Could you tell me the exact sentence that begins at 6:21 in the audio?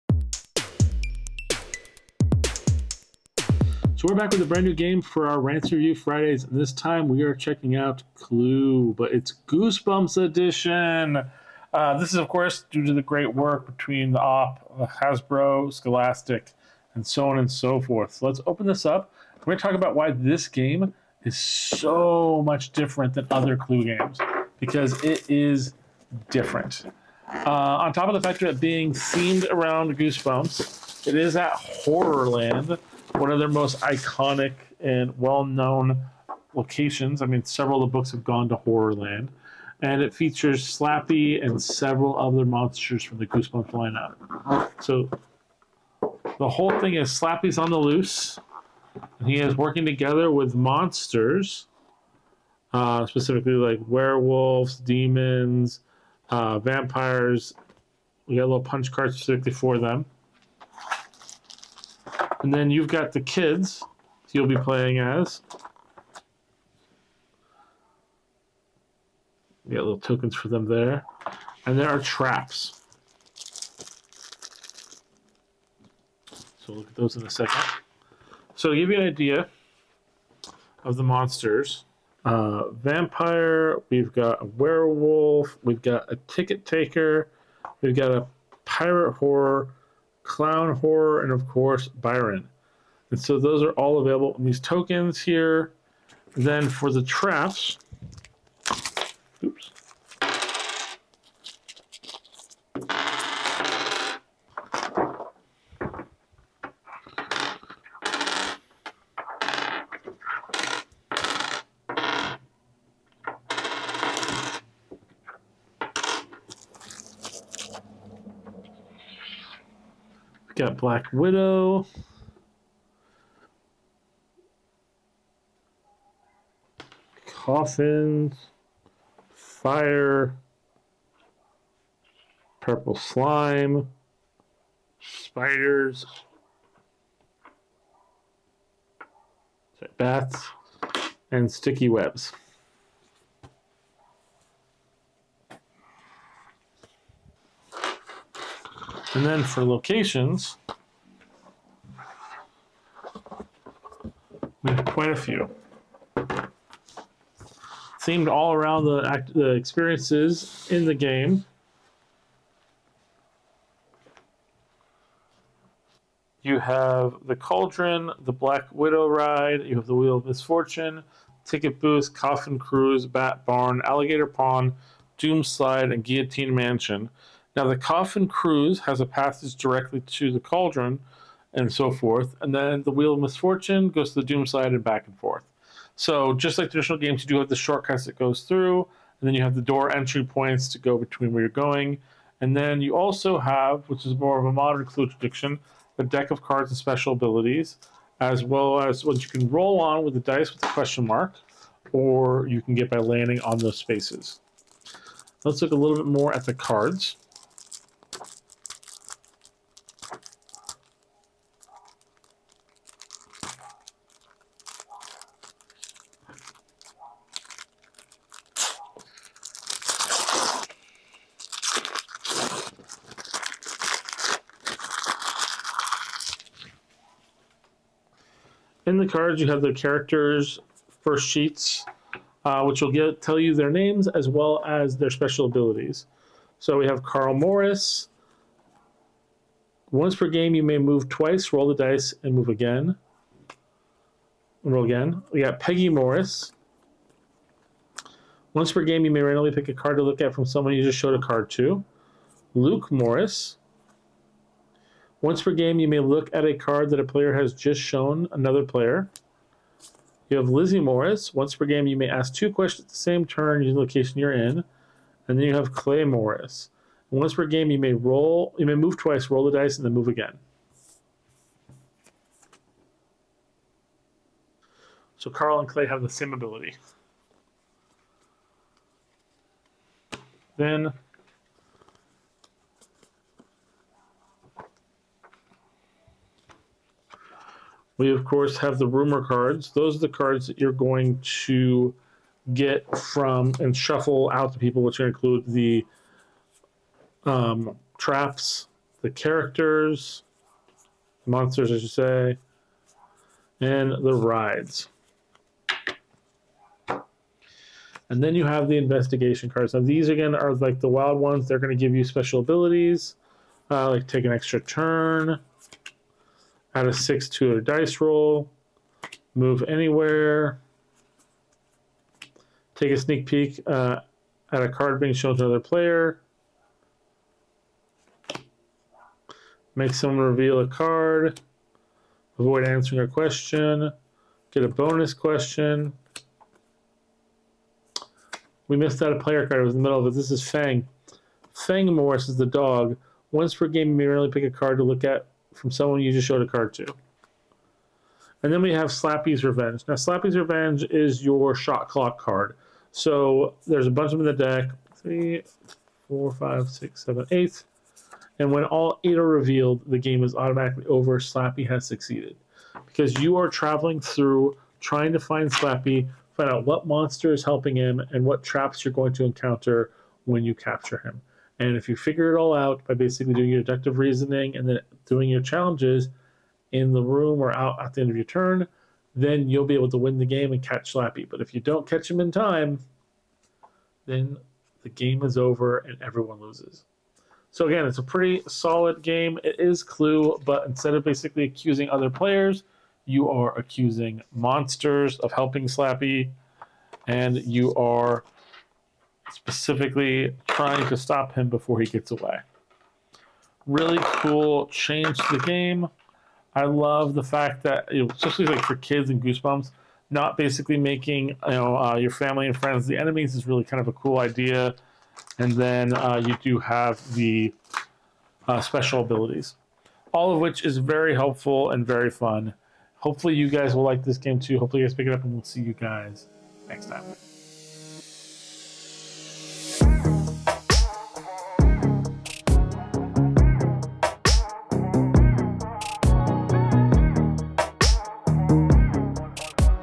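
But if you don't catch him in time, then the game is over and everyone loses.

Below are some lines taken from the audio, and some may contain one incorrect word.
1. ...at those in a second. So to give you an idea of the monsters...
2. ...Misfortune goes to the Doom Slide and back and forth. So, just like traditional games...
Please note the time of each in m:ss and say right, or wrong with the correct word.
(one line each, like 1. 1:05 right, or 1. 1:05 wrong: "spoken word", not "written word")
1. 1:16 right
2. 3:03 right.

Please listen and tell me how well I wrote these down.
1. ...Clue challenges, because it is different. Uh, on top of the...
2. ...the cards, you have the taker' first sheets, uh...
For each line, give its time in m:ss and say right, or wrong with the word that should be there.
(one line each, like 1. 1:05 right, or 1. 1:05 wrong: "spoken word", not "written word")
1. 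0:23 wrong: "games", not "challenges"
2. 3:48 wrong: "characters", not "taker".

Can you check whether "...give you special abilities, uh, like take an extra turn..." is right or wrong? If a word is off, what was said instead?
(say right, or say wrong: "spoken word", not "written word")
right.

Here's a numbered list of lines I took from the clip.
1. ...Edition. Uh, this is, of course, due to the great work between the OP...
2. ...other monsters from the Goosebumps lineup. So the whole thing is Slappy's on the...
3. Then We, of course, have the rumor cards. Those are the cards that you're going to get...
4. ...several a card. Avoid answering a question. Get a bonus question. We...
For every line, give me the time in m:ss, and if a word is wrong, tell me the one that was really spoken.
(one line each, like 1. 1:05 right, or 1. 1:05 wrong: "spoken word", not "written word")
1. 0:10 right
2. 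0:42 right
3. 4:40 right
4. 5:30 wrong: "reveal", not "several".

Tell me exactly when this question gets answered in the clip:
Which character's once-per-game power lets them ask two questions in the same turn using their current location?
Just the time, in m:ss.
4:20.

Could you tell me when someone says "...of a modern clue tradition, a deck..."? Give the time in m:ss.
3:14.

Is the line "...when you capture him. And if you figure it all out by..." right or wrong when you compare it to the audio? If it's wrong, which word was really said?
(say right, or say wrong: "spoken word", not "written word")
right.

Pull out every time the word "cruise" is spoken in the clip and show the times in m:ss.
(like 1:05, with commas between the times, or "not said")
2:52, 2:58.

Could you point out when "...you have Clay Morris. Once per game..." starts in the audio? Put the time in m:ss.
4:25.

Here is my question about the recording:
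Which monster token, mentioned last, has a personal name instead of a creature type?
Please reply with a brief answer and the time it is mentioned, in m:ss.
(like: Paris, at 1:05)
Byron, at 1:31.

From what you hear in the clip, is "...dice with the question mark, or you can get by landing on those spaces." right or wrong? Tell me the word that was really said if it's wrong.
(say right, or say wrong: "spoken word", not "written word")
right.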